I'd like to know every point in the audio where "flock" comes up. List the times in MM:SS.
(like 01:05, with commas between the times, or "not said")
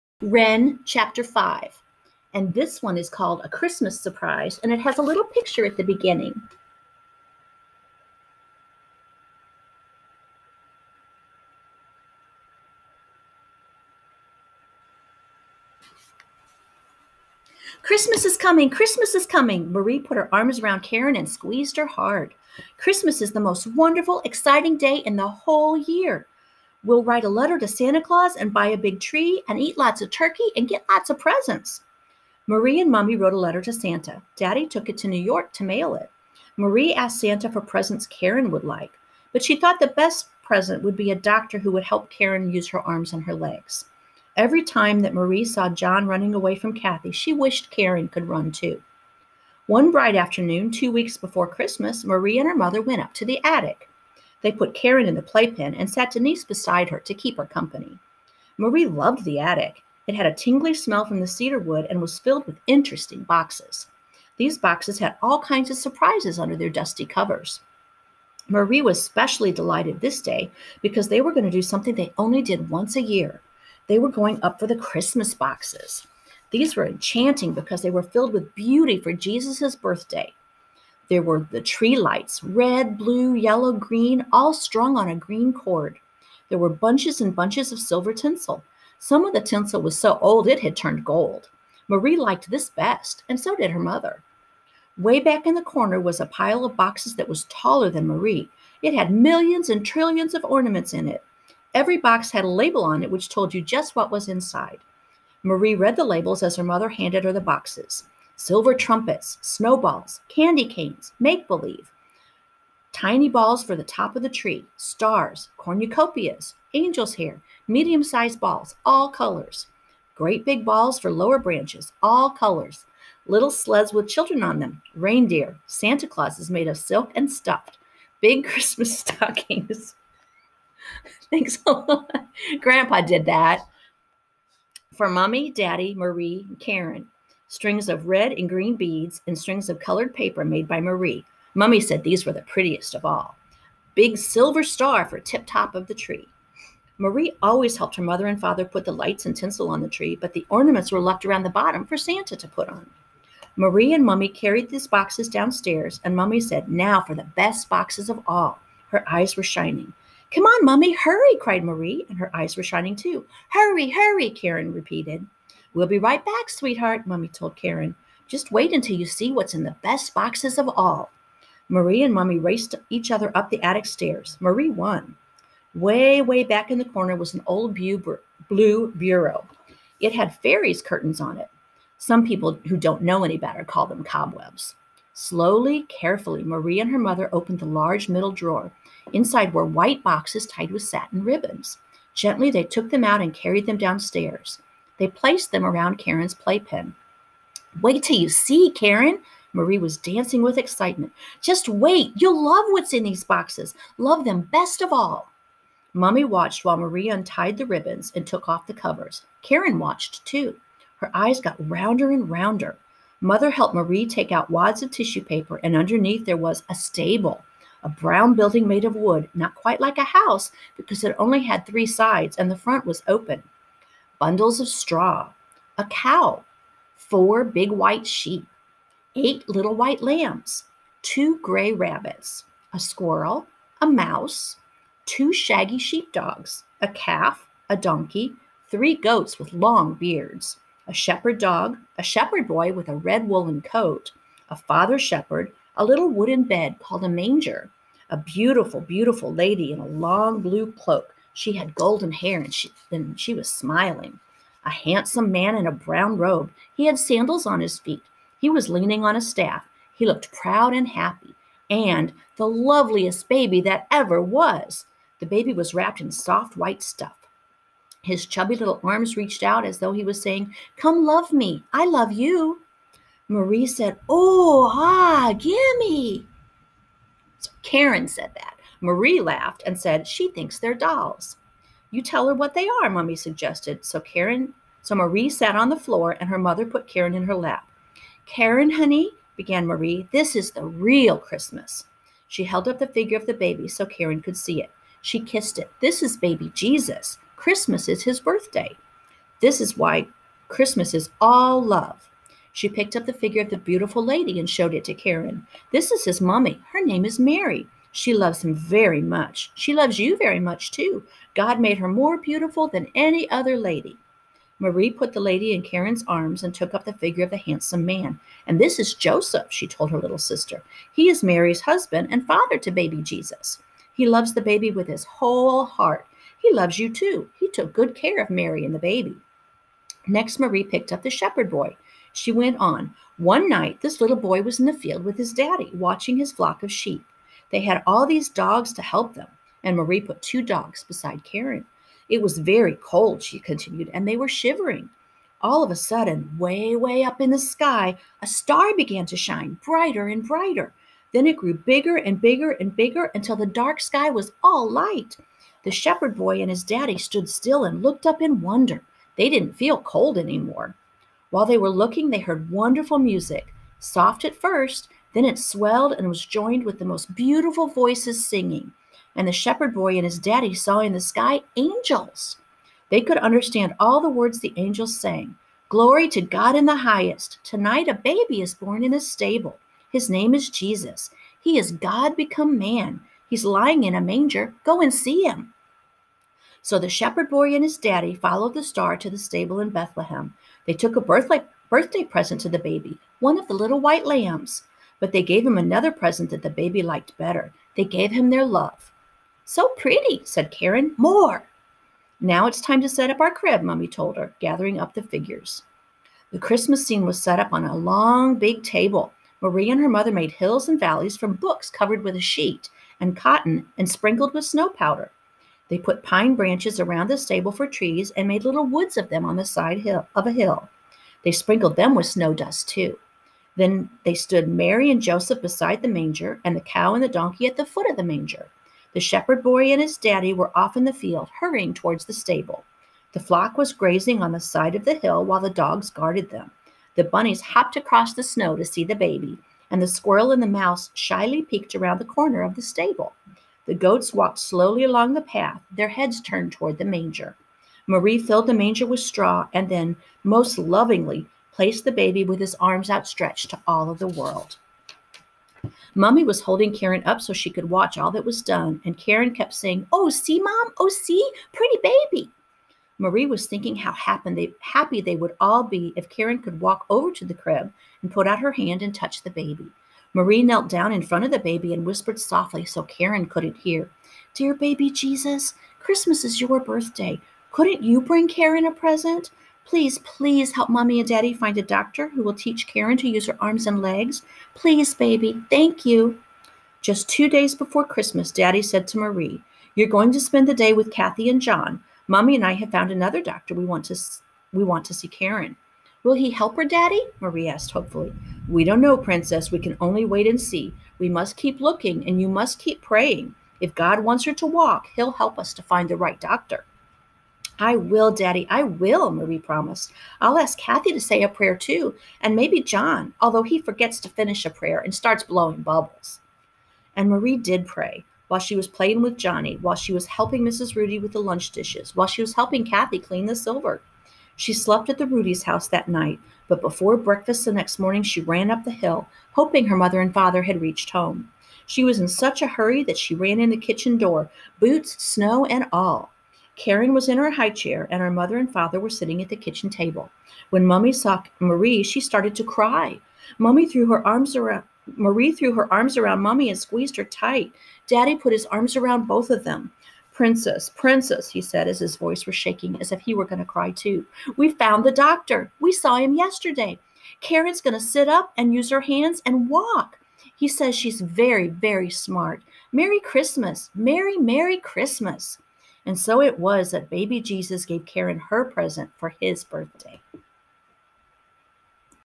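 05:36, 07:13.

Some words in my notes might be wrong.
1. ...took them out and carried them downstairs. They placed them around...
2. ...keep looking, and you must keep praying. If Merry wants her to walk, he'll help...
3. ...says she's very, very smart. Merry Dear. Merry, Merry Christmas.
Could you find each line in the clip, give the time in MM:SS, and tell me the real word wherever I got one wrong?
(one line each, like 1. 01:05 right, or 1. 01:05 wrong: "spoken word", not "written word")
1. 03:12 right
2. 08:21 wrong: "God", not "Merry"
3. 09:20 wrong: "Christmas", not "Dear".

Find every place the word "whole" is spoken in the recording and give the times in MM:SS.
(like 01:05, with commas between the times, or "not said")
00:25, 05:25.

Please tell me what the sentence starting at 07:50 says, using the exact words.
Marie knelt down in front of the baby and whispered softly so Karen couldn't hear, Dear baby Jesus, Christmas is your birthday.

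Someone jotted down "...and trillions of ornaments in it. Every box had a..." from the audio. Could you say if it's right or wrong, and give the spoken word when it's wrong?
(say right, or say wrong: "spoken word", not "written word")
right.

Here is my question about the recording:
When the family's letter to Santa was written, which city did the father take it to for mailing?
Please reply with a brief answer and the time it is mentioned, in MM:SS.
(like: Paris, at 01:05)
New York, at 00:35.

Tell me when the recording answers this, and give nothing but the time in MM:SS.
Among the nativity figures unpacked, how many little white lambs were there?
03:49.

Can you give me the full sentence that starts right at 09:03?
Mummy threw her arms around Marie threw her arms around Mummy and squeezed her tight.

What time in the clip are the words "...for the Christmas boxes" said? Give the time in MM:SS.
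01:14.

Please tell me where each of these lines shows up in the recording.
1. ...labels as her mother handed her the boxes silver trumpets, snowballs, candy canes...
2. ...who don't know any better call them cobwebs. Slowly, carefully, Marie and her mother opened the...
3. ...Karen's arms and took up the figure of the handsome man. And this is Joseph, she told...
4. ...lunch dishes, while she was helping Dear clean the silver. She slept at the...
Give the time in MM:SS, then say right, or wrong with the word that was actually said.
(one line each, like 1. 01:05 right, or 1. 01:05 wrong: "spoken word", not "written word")
1. 01:46 right
2. 03:02 right
3. 05:15 right
4. 08:41 wrong: "Kathy", not "Dear".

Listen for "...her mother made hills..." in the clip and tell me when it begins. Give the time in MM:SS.
06:49.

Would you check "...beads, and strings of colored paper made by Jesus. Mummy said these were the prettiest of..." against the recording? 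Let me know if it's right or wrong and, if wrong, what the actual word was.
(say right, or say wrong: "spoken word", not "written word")
wrong: "Marie", not "Jesus".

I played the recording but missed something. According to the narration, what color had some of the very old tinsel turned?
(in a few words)
Gold.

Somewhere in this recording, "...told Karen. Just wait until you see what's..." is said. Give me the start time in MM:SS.
02:47.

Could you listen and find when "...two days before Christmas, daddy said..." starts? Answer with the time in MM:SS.
08:07.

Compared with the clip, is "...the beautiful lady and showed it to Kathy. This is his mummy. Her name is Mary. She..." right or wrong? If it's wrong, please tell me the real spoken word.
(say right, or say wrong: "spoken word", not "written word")
wrong: "Karen", not "Kathy".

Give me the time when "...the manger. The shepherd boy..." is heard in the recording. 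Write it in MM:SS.
07:07.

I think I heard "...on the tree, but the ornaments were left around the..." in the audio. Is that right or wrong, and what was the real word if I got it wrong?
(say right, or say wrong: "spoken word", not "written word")
right.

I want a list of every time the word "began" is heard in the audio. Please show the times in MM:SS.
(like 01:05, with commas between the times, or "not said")
04:49, 05:48.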